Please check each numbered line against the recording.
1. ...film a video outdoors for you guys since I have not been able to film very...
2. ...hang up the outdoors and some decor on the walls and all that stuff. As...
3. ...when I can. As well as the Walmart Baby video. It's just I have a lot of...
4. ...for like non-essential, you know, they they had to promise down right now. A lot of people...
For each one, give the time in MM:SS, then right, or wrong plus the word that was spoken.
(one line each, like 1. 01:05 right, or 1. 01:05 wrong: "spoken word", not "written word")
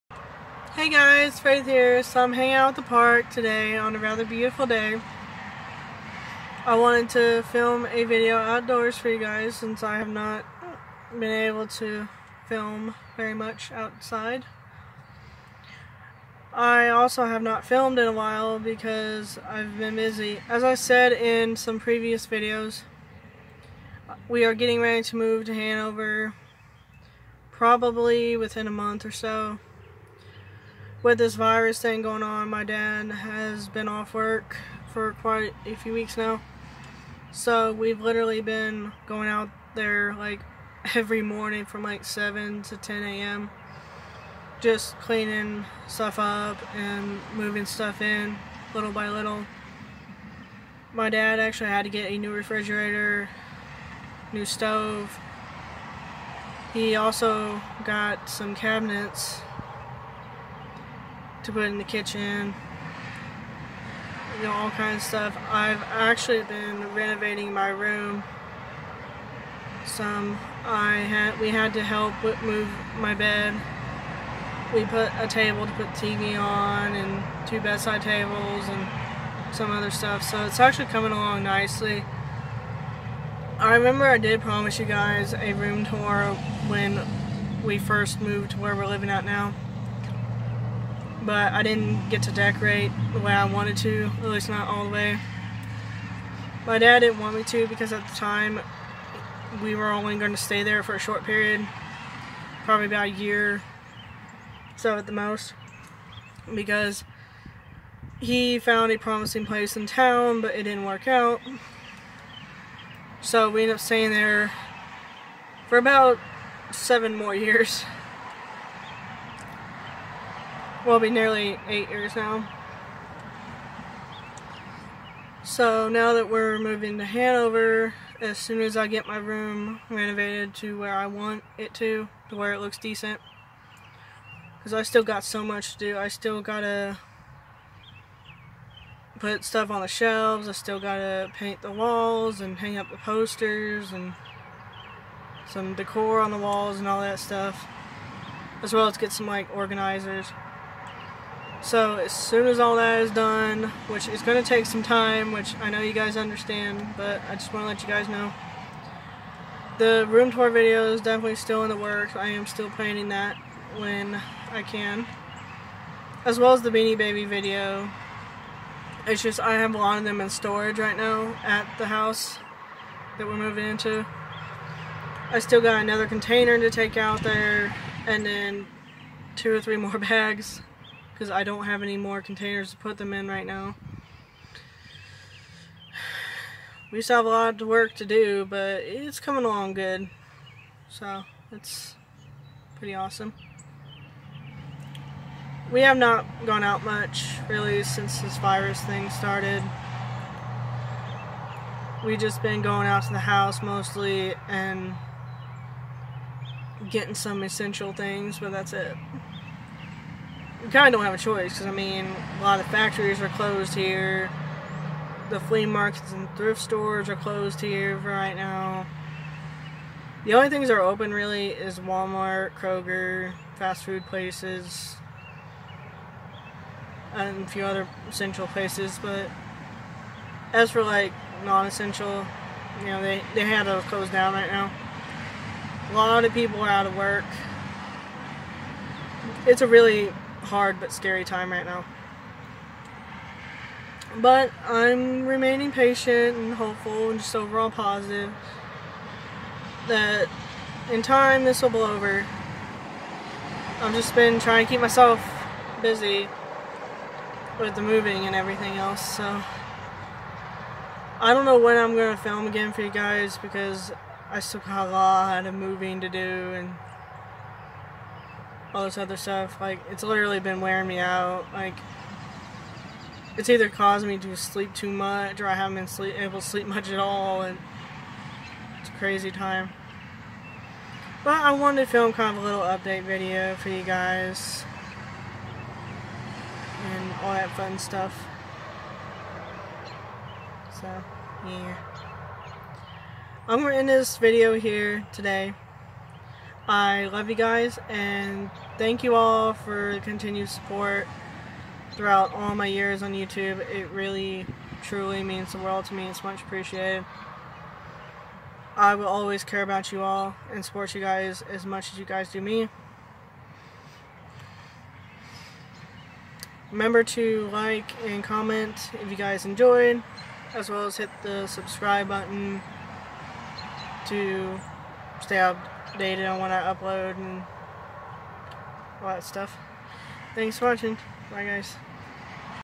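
1. 00:07 right
2. 02:22 wrong: "posters", not "outdoors"
3. 02:43 wrong: "Beanie", not "Walmart"
4. 03:50 wrong: "close", not "promise".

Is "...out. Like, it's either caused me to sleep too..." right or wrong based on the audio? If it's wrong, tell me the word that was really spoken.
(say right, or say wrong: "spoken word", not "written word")
right.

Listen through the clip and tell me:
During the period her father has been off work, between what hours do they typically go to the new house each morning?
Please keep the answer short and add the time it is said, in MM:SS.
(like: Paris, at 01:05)
7 to 10 a.m., at 00:42.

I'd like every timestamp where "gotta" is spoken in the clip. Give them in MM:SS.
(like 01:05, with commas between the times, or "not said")
02:16, 02:20.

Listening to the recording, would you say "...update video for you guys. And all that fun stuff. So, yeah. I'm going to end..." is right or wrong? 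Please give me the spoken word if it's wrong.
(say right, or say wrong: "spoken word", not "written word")
right.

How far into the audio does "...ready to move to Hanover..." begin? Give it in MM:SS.
00:24.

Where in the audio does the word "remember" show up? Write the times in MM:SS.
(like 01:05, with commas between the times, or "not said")
01:23, 05:16.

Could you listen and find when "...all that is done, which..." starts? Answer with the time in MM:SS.
02:32.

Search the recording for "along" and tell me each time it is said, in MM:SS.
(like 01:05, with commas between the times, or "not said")
01:21, 03:09.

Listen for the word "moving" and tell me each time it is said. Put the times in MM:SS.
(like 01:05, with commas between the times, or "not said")
00:47, 02:06, 02:53, 04:17, 04:25.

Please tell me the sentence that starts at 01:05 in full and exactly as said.
I've actually been renovating my room some.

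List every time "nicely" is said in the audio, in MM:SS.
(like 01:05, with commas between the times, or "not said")
01:21.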